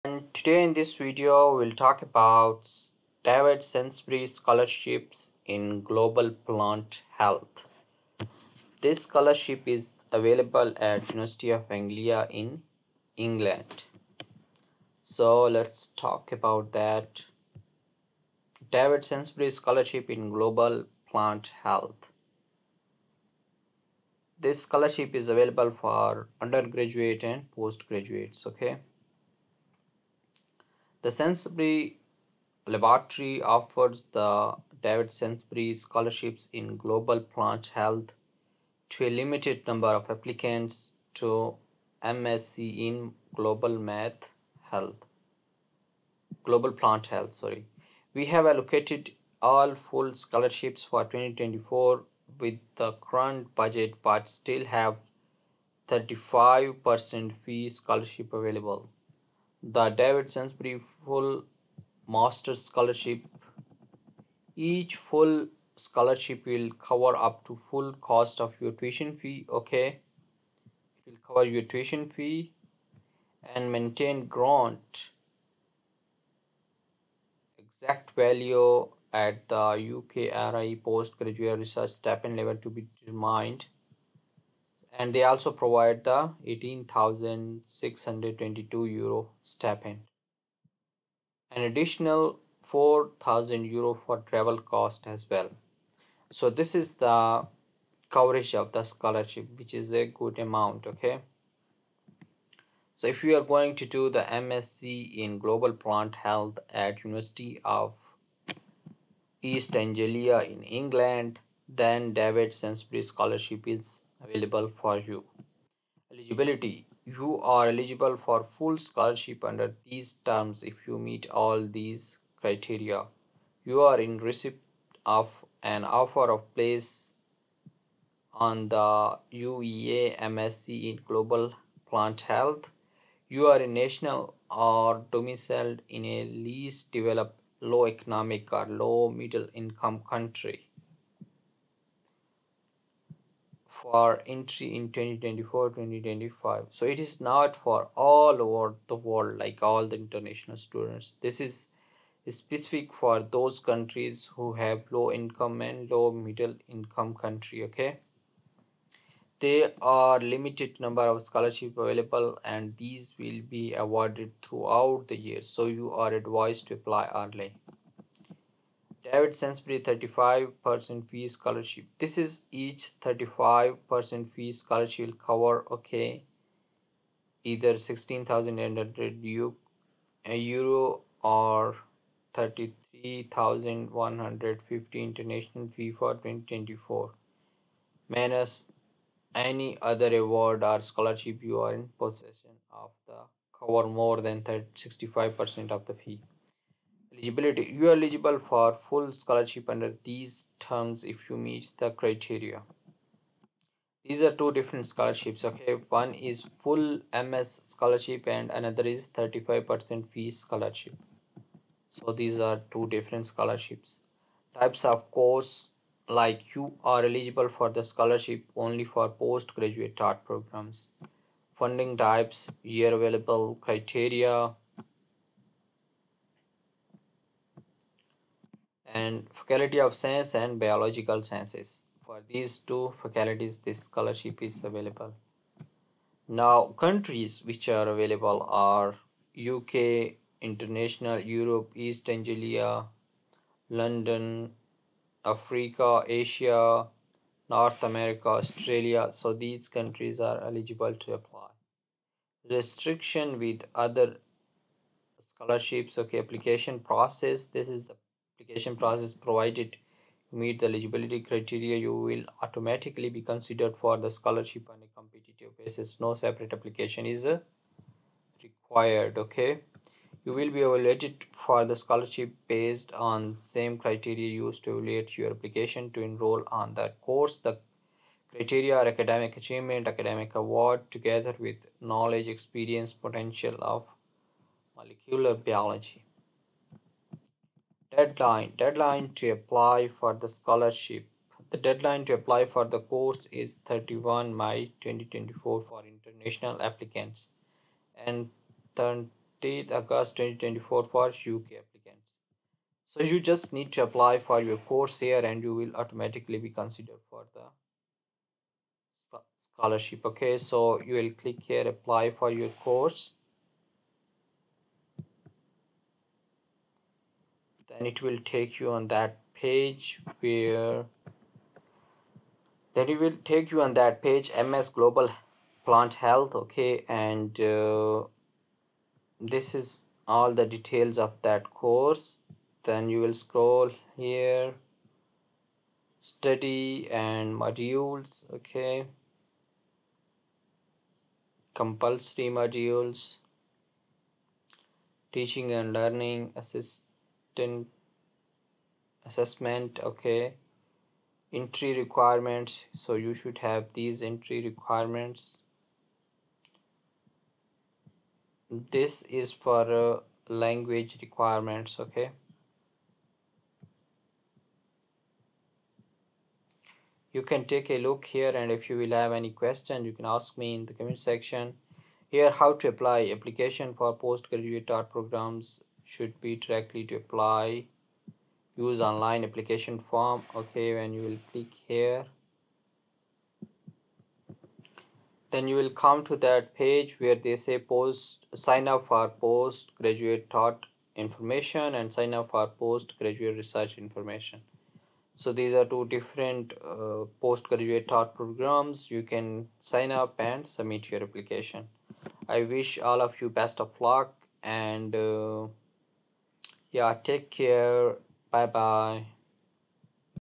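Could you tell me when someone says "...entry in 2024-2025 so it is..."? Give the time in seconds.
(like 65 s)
144 s.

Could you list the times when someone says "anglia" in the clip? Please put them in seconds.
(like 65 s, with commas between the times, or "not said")
11 s, 109 s, 242 s.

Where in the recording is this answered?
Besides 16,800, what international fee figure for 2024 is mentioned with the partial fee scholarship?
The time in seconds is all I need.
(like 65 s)
182 s.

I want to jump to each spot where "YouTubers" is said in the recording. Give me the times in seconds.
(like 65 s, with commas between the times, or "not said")
not said.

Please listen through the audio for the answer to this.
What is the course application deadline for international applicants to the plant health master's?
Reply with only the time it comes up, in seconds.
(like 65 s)
293 s.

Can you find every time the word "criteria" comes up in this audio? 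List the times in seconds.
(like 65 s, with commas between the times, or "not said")
122 s, 201 s, 223 s, 261 s, 273 s, 278 s.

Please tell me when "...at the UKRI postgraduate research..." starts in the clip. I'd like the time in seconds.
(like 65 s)
79 s.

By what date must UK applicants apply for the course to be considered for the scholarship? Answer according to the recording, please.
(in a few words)
30 August 2024.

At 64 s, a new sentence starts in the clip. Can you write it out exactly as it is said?
Each full scholarship will cover up to full cost of your tuition fee.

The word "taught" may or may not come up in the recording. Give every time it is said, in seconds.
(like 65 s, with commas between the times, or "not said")
219 s, 374 s, 390 s, 397 s.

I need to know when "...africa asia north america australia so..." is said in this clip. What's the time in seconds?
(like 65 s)
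245 s.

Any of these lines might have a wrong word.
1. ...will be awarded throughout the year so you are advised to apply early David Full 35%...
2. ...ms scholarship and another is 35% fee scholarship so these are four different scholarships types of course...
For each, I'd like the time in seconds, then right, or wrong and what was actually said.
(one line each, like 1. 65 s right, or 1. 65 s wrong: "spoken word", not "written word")
1. 163 s wrong: "Sainsbury", not "Full"
2. 207 s wrong: "two", not "four".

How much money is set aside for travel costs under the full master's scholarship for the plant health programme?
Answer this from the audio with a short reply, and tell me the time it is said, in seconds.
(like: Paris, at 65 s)
4,000 euro, at 92 s.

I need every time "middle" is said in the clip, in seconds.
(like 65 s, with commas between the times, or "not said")
139 s, 156 s.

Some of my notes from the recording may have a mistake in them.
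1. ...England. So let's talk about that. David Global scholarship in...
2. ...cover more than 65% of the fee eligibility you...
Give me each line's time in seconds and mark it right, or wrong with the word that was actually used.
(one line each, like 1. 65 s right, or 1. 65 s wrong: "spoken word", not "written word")
1. 13 s wrong: "Sainsbury", not "Global"
2. 193 s right.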